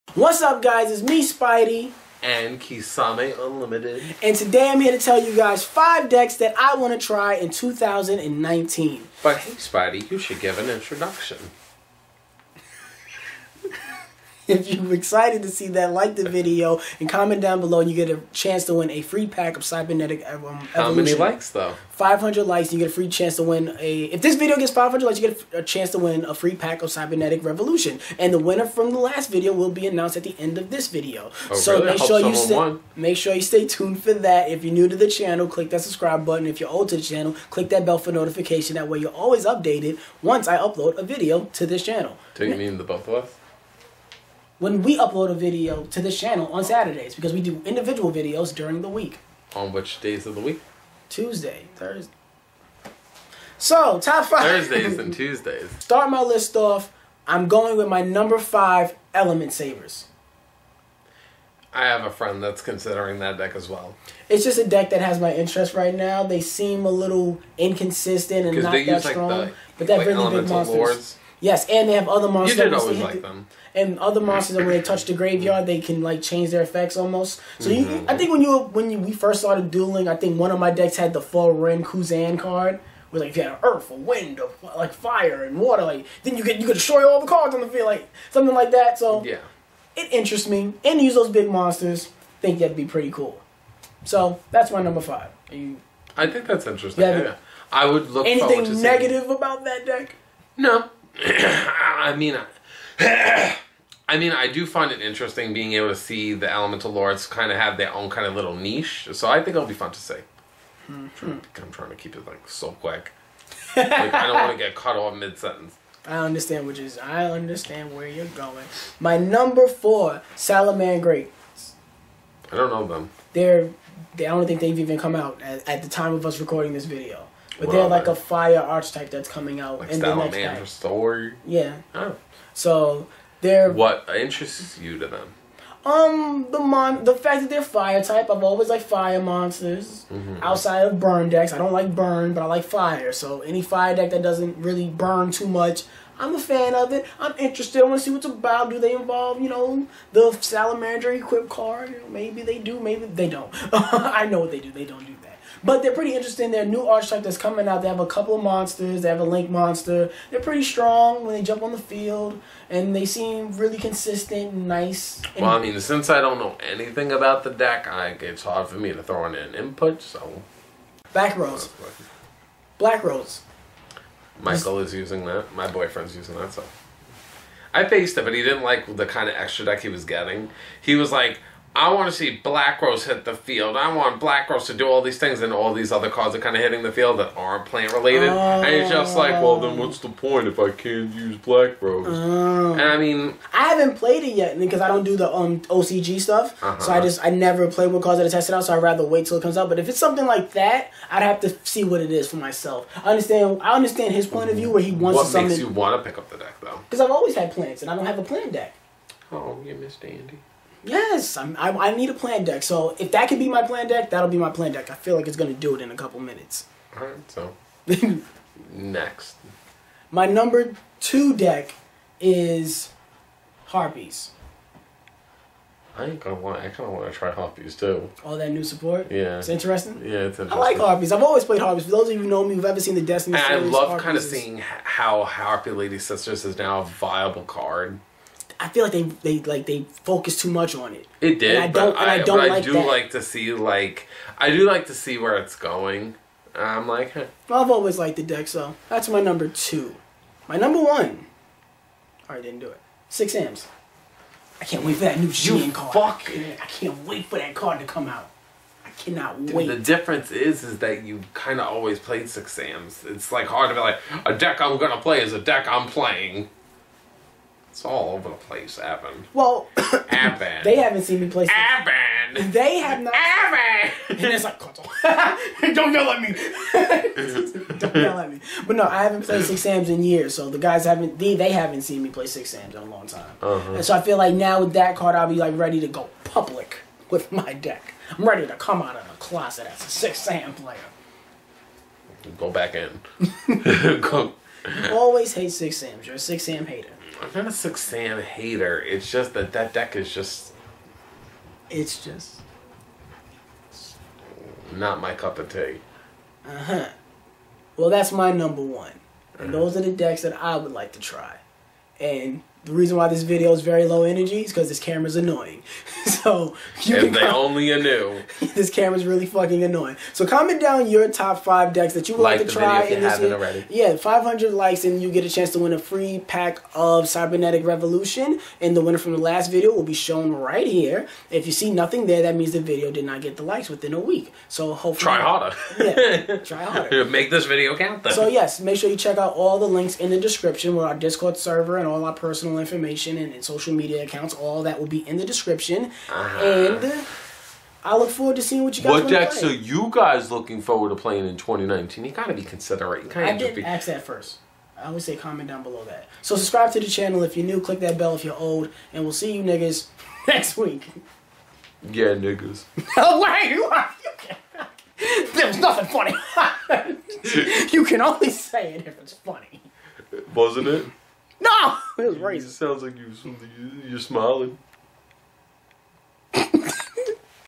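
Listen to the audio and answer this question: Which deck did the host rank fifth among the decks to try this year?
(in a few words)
Elementsabers.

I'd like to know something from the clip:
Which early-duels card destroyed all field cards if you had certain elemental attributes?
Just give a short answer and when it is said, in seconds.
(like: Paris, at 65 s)
Fuh-Rin-Ka-Zan, at 81 s.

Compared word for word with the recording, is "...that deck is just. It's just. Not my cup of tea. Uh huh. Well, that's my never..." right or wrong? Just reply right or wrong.
wrong.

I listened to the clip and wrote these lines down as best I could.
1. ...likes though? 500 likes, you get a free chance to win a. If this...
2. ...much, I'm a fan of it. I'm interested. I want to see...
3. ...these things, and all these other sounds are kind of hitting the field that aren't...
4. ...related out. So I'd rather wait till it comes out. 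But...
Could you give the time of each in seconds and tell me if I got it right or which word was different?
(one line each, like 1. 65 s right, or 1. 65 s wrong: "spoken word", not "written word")
1. 21 s right
2. 145 s right
3. 185 s wrong: "cards", not "sounds"
4. 198 s wrong: "tested", not "related".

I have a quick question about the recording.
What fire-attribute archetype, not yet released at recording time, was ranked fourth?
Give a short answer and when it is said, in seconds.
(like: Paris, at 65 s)
Salamangreats, at 120 s.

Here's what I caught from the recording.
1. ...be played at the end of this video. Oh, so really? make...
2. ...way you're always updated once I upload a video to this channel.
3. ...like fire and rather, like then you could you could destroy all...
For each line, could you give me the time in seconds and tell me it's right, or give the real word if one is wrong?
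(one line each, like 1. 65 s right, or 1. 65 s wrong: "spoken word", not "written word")
1. 29 s wrong: "announced", not "played"
2. 38 s right
3. 84 s wrong: "water", not "rather".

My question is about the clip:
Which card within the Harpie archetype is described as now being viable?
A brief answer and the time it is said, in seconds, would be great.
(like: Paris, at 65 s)
Harpy Lady Sisters, at 235 s.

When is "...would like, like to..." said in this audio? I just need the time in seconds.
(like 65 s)
322 s.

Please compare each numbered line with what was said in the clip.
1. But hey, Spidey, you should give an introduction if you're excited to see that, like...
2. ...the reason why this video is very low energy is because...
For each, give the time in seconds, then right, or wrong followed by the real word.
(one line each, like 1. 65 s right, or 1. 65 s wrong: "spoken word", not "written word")
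1. 9 s right
2. 312 s right.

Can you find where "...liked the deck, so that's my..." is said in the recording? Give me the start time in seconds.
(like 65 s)
247 s.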